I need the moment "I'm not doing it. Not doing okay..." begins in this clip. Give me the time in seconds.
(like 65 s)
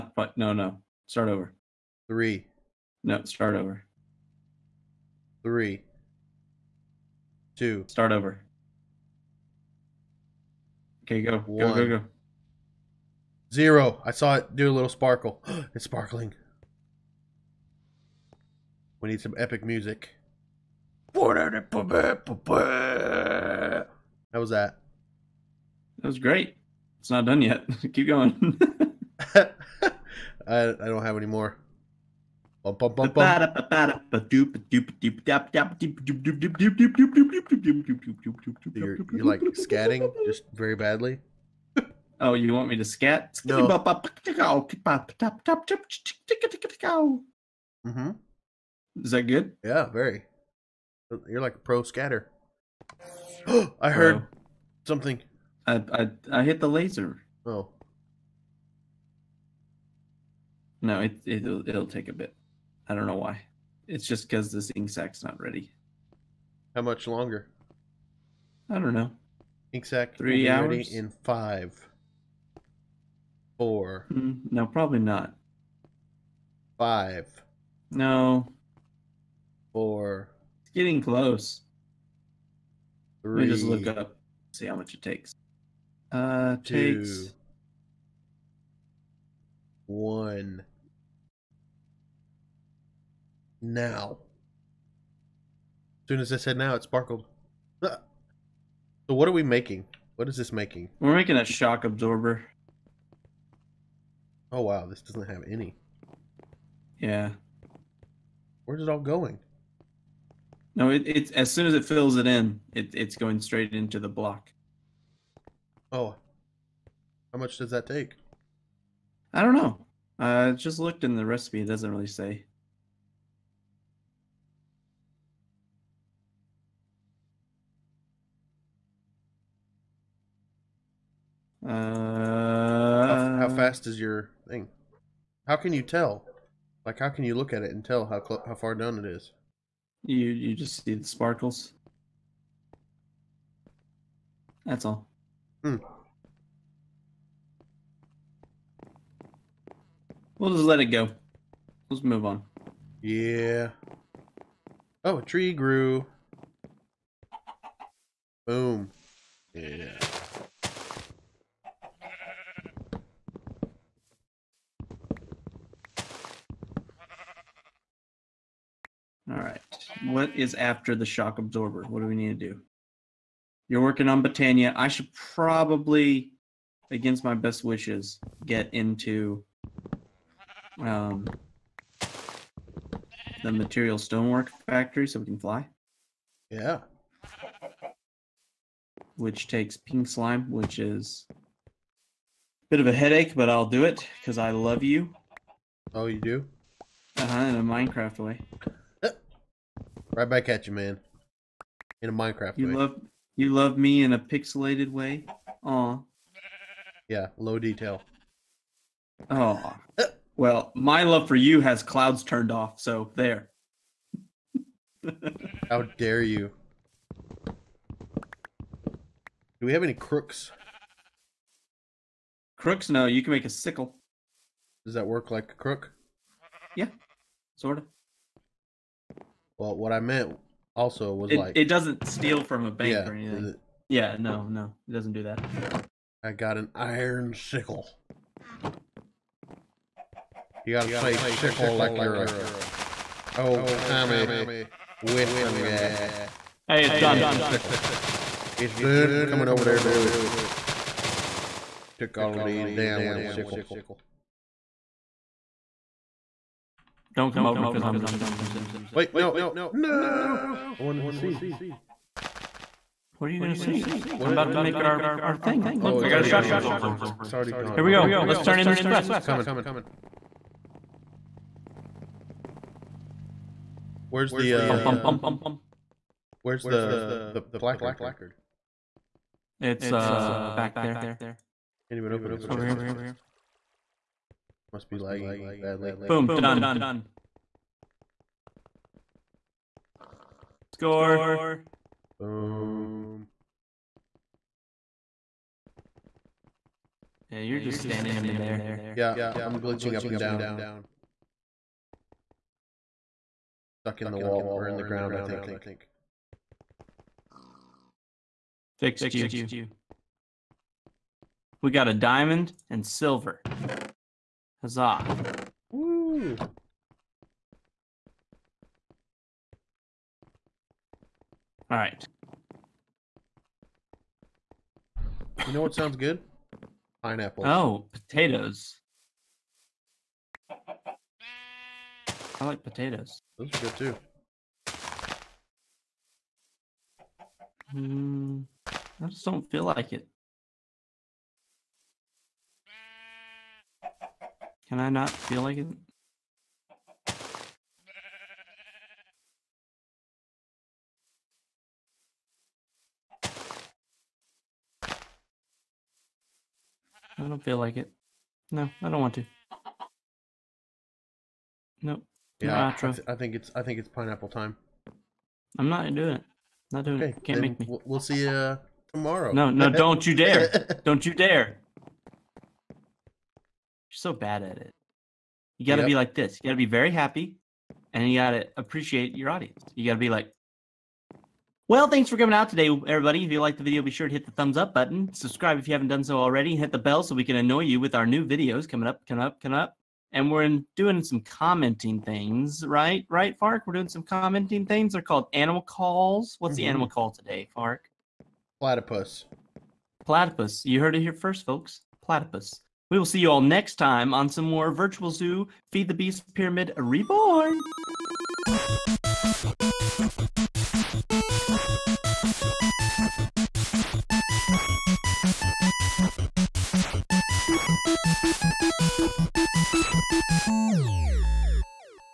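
365 s.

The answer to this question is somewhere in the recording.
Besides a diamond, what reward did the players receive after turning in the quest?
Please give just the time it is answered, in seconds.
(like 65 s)
312 s.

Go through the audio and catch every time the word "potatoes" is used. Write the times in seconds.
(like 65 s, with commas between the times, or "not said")
327 s, 332 s.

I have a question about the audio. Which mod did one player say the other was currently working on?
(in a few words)
Botania.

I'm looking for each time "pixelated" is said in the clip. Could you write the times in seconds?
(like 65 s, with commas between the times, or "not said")
204 s.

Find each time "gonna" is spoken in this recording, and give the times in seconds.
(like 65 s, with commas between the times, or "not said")
258 s, 263 s.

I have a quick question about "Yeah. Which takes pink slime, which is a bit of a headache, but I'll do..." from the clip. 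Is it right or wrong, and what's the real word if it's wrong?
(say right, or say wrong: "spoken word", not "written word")
right.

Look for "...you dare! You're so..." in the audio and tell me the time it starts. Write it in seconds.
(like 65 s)
371 s.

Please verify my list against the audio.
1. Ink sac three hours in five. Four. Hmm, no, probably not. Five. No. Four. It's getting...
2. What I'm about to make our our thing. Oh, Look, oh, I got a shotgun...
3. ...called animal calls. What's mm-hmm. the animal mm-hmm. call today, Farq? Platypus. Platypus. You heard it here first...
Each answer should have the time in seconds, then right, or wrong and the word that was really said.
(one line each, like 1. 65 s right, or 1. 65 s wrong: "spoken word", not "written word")
1. 69 s right
2. 264 s right
3. 395 s right.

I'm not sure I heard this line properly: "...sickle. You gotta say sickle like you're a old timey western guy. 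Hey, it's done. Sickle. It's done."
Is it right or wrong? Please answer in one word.
right.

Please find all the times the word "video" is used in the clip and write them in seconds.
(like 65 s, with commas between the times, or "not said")
383 s, 388 s.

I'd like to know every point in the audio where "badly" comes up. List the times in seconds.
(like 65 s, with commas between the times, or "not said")
40 s, 285 s.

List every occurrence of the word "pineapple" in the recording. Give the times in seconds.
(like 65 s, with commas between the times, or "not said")
327 s, 363 s.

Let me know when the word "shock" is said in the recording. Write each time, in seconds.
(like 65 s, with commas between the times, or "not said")
101 s, 171 s.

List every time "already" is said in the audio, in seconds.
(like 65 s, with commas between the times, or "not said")
267 s, 386 s.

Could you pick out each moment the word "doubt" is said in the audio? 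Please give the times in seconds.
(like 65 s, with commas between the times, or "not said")
not said.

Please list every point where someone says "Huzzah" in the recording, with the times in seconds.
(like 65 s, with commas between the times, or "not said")
314 s.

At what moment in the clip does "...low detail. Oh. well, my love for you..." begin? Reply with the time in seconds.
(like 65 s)
207 s.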